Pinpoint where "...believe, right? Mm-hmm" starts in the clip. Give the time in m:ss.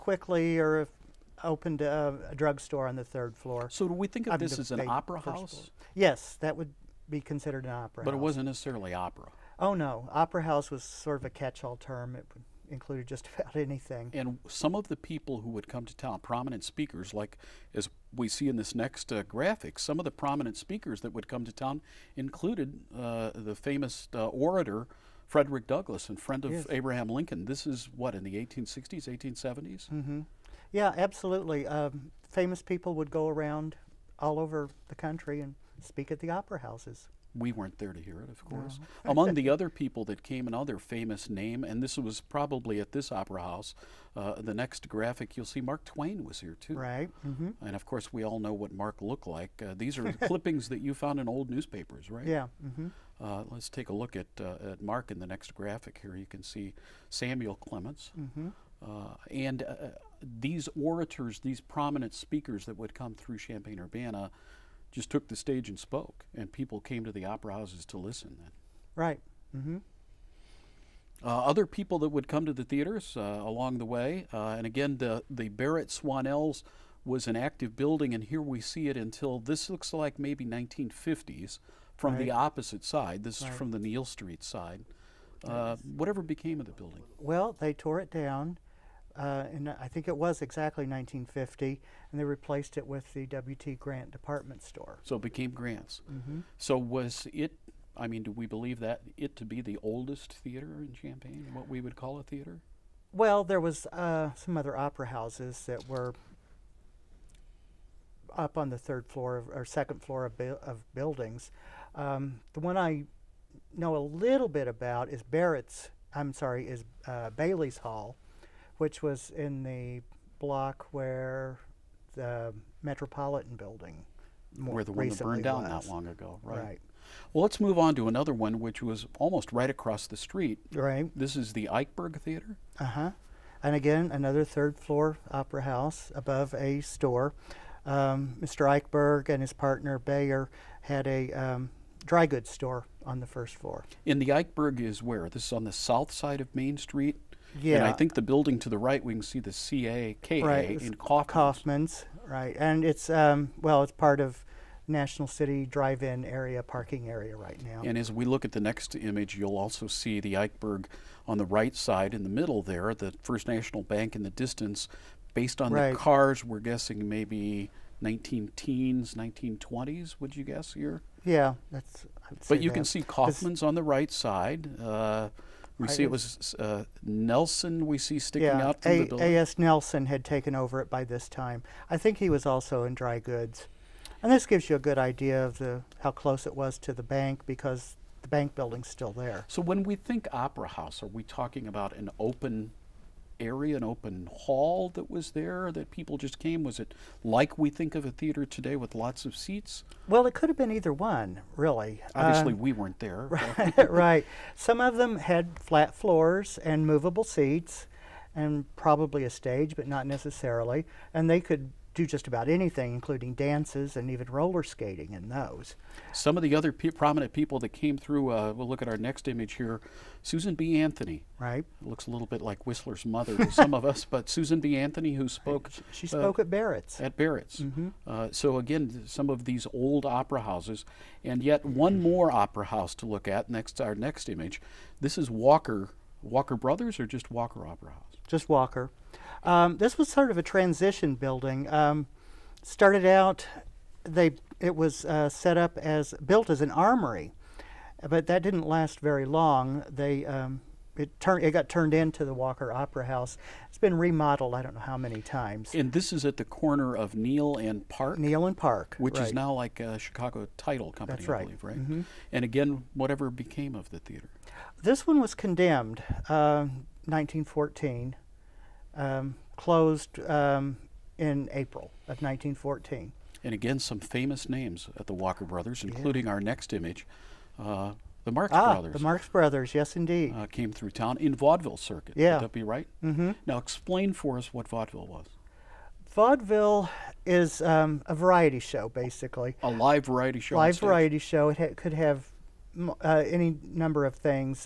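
4:21.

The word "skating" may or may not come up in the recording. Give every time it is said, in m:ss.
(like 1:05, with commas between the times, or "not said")
3:34.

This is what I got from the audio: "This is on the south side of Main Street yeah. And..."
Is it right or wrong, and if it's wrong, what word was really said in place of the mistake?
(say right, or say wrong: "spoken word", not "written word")
right.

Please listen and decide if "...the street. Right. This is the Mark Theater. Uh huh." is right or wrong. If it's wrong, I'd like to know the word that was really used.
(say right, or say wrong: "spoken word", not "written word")
wrong: "Eichberg", not "Mark".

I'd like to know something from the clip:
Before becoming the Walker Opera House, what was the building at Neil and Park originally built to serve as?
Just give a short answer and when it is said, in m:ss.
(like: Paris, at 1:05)
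An armory, at 4:06.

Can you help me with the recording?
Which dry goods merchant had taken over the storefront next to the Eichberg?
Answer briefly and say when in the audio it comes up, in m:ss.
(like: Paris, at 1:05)
A.S. Nelson, at 2:59.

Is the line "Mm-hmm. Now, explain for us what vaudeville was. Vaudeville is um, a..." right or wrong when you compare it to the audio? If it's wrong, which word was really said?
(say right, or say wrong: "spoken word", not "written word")
right.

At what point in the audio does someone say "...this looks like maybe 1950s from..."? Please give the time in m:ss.
1:19.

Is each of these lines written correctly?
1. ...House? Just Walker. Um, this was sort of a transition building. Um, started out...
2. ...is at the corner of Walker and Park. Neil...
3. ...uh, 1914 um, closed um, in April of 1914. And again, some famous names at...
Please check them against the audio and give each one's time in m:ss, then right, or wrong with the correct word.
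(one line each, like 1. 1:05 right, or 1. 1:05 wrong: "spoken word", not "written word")
1. 3:57 right
2. 4:16 wrong: "Neil", not "Walker"
3. 4:26 right.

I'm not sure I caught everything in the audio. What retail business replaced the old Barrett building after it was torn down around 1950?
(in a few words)
W.T. Grant department store.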